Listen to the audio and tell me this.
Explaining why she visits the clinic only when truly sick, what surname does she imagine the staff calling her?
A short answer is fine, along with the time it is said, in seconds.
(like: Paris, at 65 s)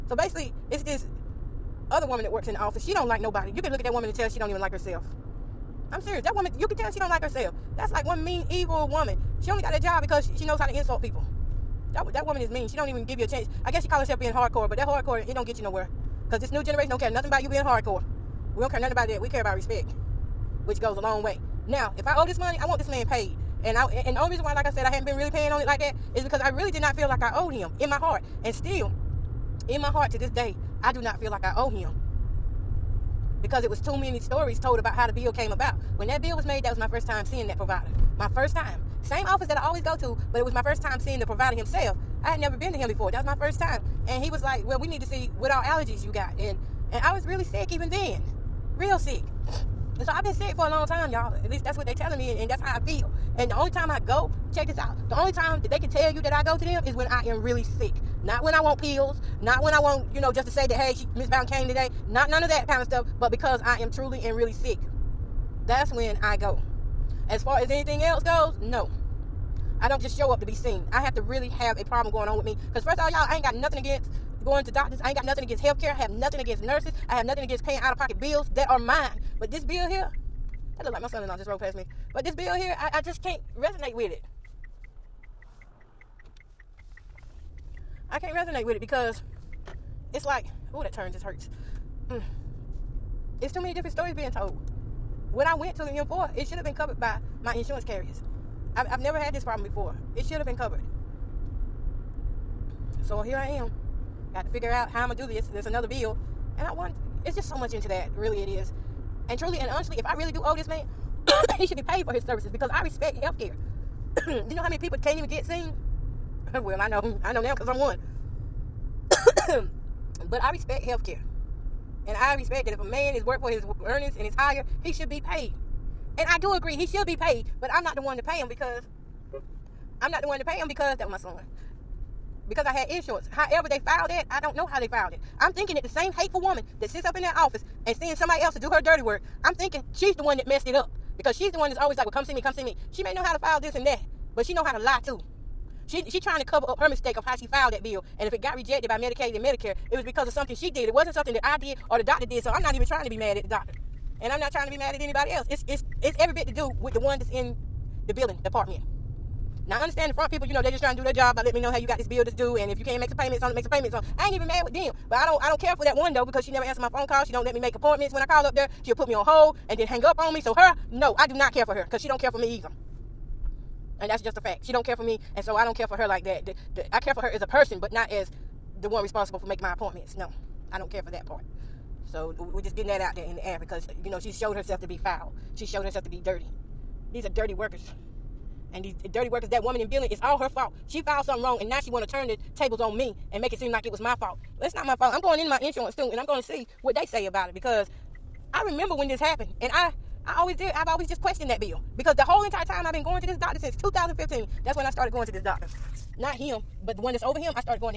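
Bowden, at 61 s.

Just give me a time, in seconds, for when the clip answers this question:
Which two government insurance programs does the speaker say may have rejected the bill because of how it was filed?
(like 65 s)
148 s.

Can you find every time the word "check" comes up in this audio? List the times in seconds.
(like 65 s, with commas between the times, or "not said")
54 s.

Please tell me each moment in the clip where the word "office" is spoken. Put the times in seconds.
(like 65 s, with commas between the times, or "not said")
2 s, 39 s, 137 s.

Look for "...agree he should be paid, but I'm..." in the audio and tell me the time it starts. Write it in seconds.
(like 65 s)
126 s.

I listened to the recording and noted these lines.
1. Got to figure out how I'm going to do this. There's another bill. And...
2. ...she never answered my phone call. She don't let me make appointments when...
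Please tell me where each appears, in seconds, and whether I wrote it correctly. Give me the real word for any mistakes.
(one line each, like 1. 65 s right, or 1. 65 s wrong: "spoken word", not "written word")
1. 104 s right
2. 166 s right.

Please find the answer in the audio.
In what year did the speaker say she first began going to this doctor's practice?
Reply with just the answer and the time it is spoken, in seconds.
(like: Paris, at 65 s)
2015, at 203 s.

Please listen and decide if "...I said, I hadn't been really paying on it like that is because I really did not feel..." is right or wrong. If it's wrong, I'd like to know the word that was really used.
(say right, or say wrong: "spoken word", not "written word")
right.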